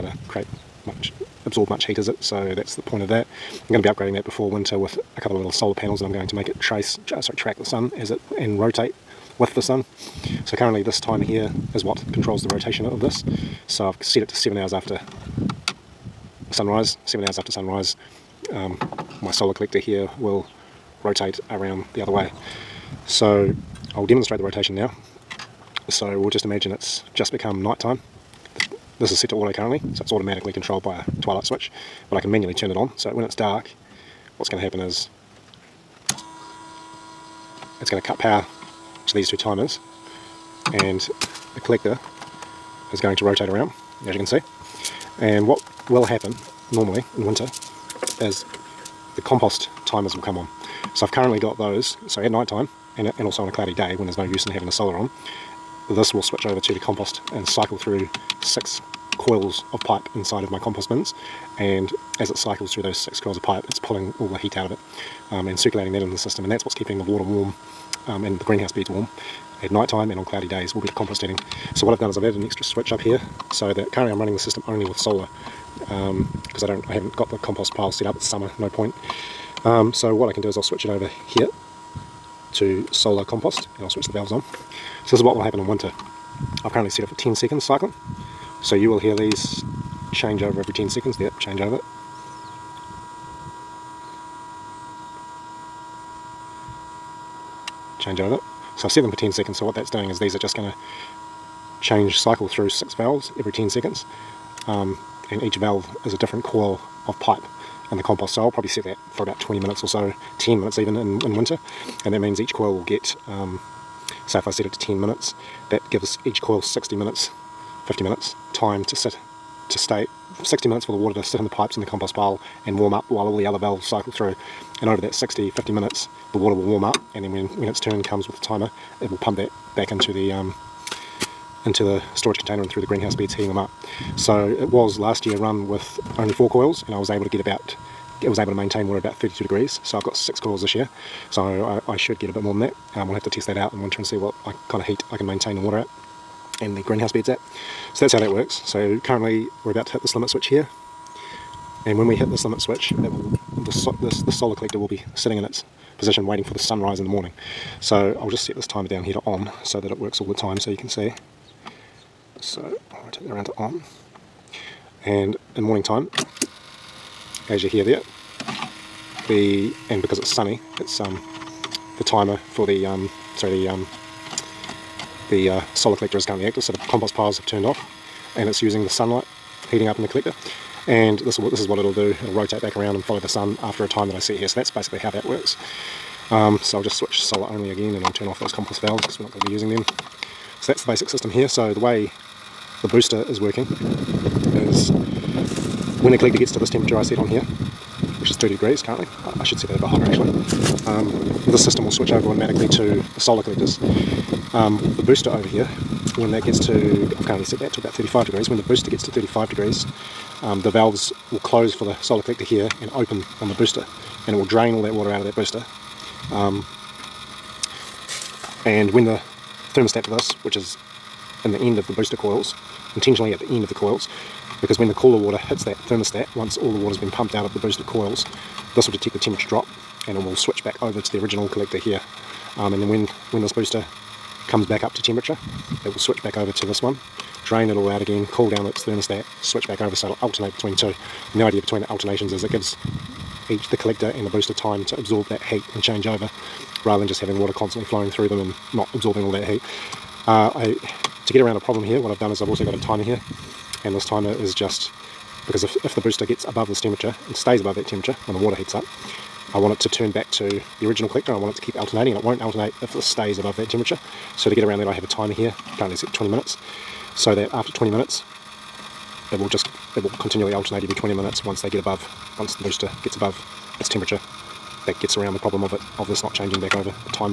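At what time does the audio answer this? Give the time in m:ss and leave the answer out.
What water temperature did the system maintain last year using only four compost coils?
2:19.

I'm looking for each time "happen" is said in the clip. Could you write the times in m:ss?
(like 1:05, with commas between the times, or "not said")
0:34, 0:46, 1:25.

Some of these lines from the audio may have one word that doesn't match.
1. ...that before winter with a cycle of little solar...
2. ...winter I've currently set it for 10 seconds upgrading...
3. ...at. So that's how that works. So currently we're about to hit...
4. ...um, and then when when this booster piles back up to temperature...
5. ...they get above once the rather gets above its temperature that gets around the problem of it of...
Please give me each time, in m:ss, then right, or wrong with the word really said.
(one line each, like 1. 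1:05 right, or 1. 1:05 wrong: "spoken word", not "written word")
1. 0:04 wrong: "couple", not "cycle"
2. 1:25 wrong: "cycling", not "upgrading"
3. 2:27 right
4. 3:52 wrong: "comes", not "piles"
5. 4:31 wrong: "booster", not "rather".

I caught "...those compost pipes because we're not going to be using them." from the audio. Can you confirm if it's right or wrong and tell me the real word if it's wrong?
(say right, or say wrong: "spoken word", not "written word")
wrong: "valves", not "pipes".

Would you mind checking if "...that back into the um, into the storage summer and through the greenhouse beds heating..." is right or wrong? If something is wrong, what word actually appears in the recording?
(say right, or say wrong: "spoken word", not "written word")
wrong: "container", not "summer".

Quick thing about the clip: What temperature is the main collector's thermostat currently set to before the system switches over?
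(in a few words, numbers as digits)
30 degrees.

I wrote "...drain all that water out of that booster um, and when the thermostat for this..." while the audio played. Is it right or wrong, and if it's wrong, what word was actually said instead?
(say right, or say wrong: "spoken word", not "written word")
right.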